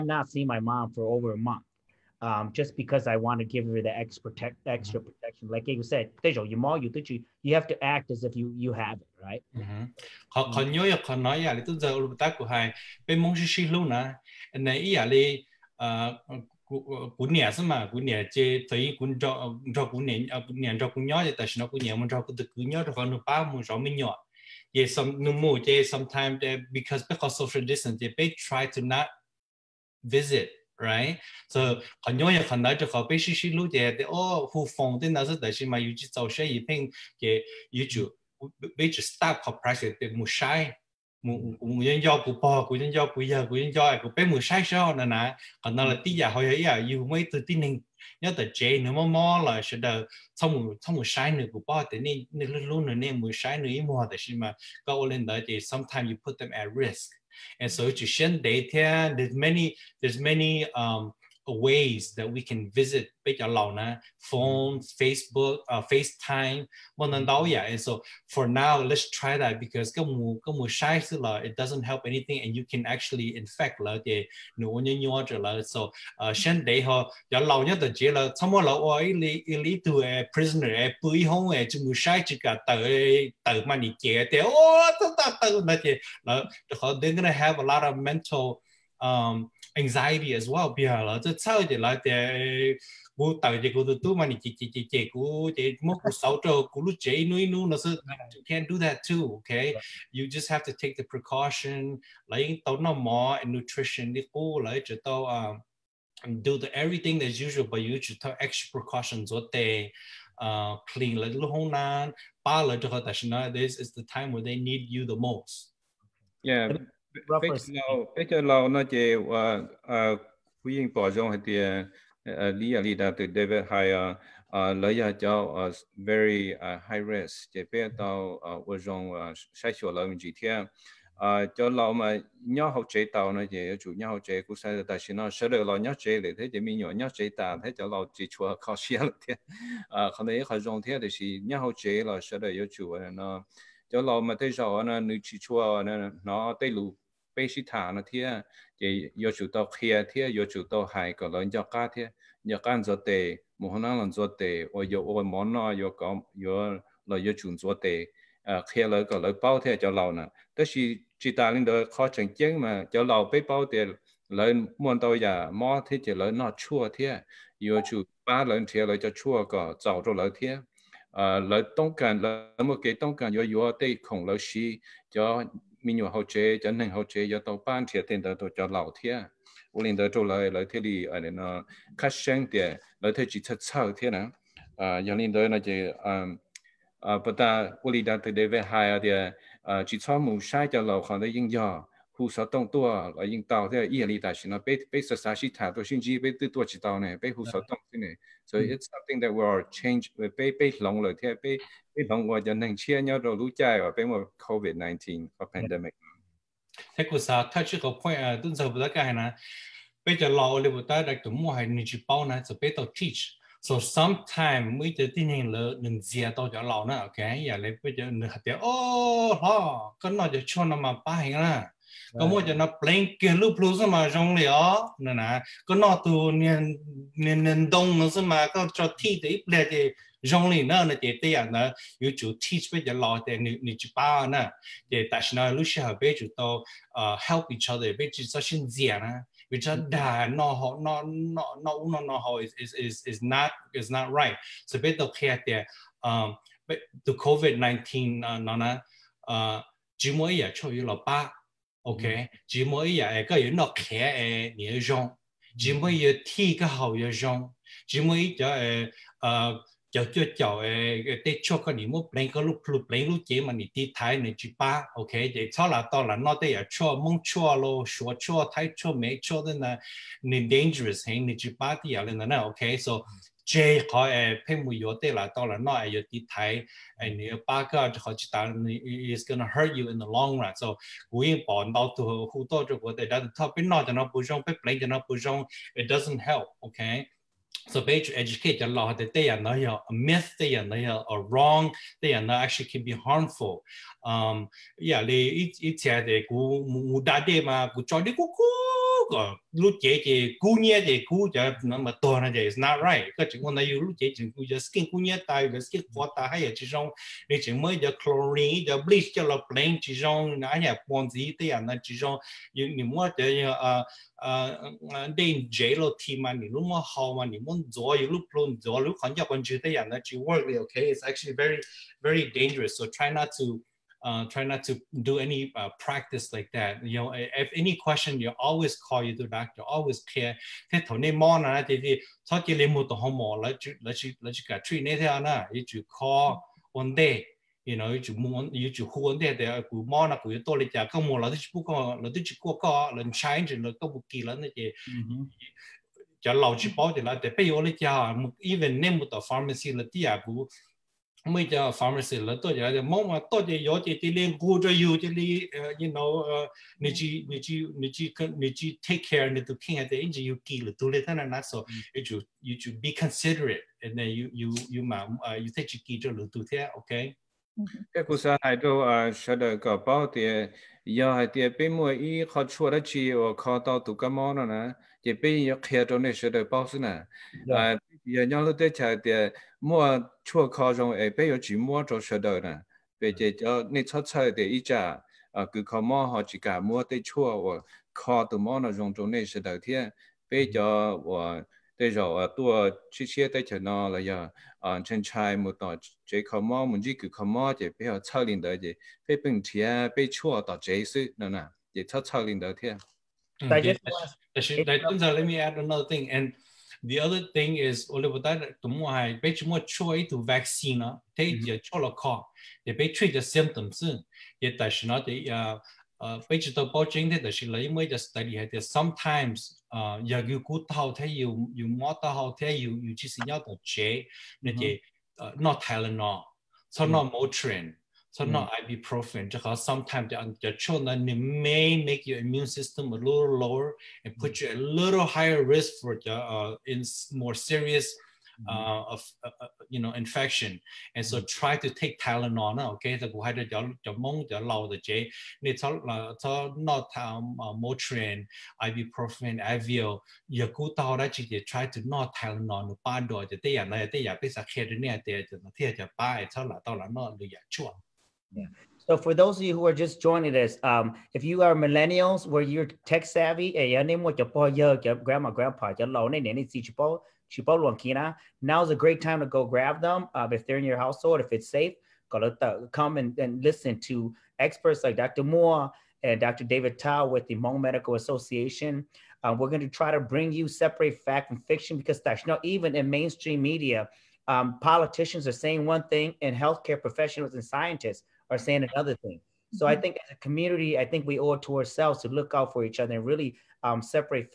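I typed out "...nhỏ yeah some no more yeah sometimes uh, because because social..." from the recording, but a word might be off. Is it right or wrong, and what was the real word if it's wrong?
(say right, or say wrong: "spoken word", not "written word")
right.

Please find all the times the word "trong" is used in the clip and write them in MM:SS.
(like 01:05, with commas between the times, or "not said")
02:01, 02:08, 03:44, 03:50, 06:20, 06:28.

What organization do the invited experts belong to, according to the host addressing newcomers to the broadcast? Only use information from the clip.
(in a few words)
Hmong Medical Association.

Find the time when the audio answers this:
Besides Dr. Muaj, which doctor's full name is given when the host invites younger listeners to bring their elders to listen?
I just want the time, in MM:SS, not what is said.
07:56.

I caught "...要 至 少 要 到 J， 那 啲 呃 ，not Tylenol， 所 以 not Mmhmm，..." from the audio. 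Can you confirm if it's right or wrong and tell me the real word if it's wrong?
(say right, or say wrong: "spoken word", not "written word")
wrong: "Motrin", not "Mmhmm".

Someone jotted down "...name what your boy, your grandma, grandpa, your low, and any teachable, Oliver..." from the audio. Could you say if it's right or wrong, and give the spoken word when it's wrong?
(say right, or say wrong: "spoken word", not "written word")
wrong: "Chipotle", not "Oliver".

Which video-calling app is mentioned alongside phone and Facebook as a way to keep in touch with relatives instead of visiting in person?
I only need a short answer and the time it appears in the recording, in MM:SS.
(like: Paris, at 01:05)
FaceTime, at 01:05.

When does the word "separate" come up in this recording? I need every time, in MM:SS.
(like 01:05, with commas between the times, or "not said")
08:00, 08:13.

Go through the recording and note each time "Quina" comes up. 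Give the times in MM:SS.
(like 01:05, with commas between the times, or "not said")
07:47.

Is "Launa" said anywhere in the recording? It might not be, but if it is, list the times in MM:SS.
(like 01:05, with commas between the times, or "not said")
01:03.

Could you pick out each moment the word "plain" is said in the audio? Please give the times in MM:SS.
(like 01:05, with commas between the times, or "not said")
03:42, 05:09.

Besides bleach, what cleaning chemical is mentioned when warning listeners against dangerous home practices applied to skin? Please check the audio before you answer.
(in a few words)
chlorine.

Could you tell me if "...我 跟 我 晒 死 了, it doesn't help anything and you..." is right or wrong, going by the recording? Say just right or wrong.
right.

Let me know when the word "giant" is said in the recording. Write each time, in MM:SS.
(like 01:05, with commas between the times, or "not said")
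not said.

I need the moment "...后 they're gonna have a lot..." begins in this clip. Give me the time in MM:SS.
01:26.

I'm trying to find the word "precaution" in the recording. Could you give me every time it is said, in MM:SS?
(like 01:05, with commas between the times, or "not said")
01:41, 01:48.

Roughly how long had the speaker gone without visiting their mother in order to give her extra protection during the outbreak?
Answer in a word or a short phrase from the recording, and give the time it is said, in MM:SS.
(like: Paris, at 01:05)
over a month, at 00:01.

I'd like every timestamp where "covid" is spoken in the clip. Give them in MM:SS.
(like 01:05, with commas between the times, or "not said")
03:24, 04:07.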